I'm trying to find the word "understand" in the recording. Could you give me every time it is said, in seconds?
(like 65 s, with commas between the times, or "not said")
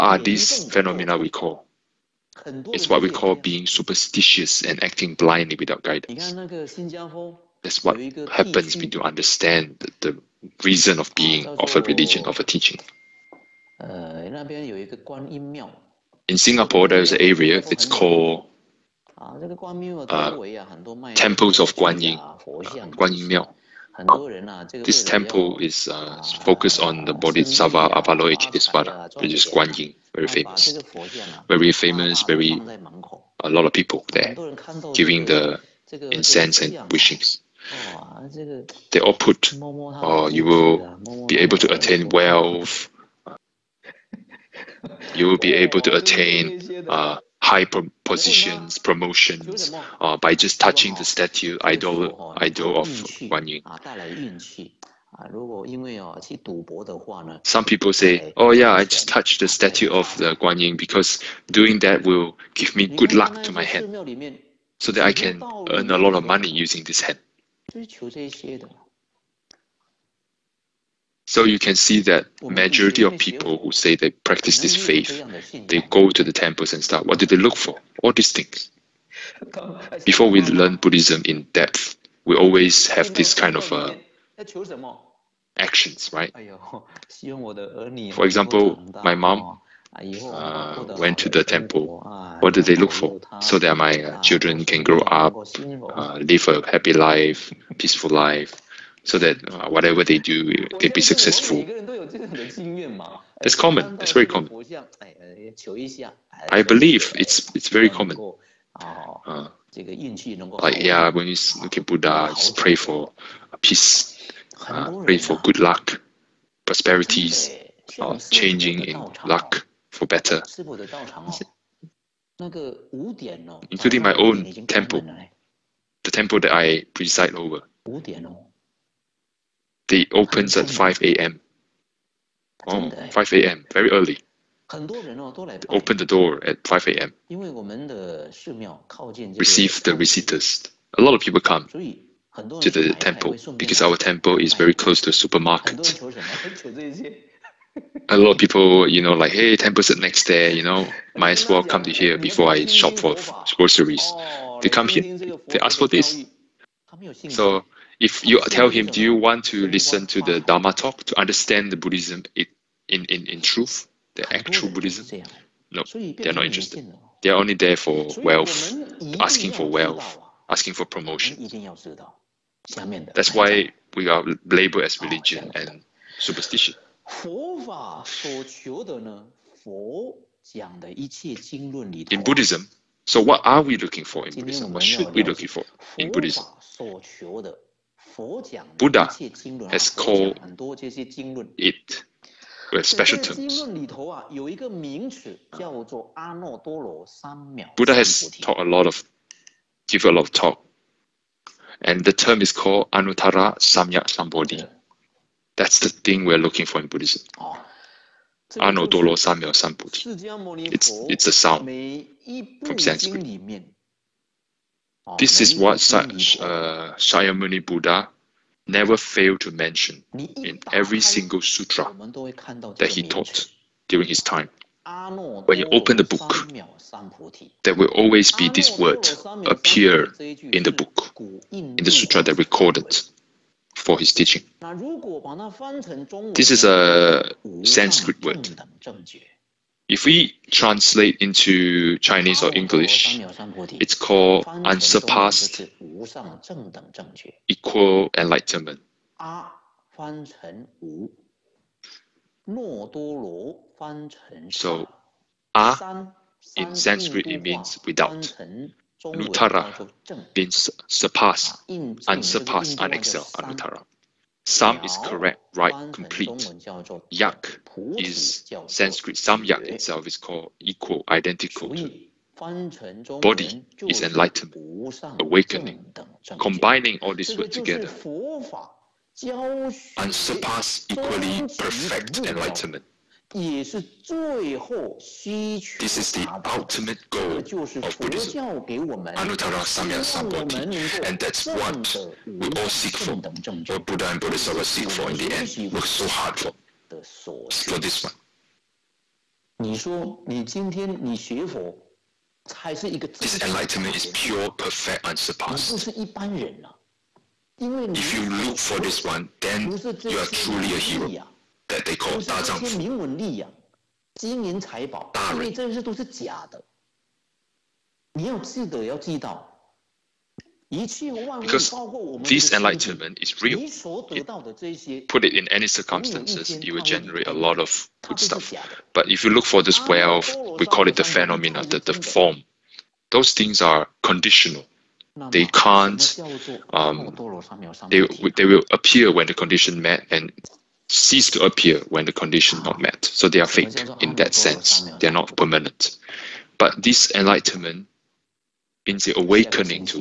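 9 s, 161 s.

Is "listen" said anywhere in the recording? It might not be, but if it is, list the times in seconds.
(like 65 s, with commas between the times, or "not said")
159 s.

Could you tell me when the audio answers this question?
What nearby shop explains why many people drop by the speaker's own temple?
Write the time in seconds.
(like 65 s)
145 s.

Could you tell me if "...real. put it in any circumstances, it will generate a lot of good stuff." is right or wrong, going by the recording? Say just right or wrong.
right.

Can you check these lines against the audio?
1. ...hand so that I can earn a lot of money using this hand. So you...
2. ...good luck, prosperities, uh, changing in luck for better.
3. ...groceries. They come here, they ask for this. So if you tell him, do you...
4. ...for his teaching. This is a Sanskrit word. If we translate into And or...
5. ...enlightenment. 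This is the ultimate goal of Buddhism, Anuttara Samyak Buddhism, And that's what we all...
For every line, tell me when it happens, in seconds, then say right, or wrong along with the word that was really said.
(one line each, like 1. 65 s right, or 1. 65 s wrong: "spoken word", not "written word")
1. 63 s right
2. 115 s right
3. 153 s right
4. 233 s wrong: "Chinese", not "And"
5. 282 s wrong: "Sambodhi", not "Buddhism".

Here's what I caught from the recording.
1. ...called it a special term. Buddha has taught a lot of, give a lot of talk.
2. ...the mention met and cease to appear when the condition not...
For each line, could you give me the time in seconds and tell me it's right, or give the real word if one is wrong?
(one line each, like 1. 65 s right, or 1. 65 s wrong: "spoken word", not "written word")
1. 189 s right
2. 339 s wrong: "condition", not "mention".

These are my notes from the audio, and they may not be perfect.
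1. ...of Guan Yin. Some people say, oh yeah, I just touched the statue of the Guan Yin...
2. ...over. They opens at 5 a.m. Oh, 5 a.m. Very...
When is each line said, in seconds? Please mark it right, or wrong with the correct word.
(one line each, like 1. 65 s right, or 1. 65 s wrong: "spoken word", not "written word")
1. 52 s right
2. 127 s right.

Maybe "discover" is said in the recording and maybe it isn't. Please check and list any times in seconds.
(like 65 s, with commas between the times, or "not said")
not said.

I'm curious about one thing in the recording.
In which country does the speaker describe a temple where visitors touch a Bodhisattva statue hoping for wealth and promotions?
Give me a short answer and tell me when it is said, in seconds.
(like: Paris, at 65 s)
Singapore, at 16 s.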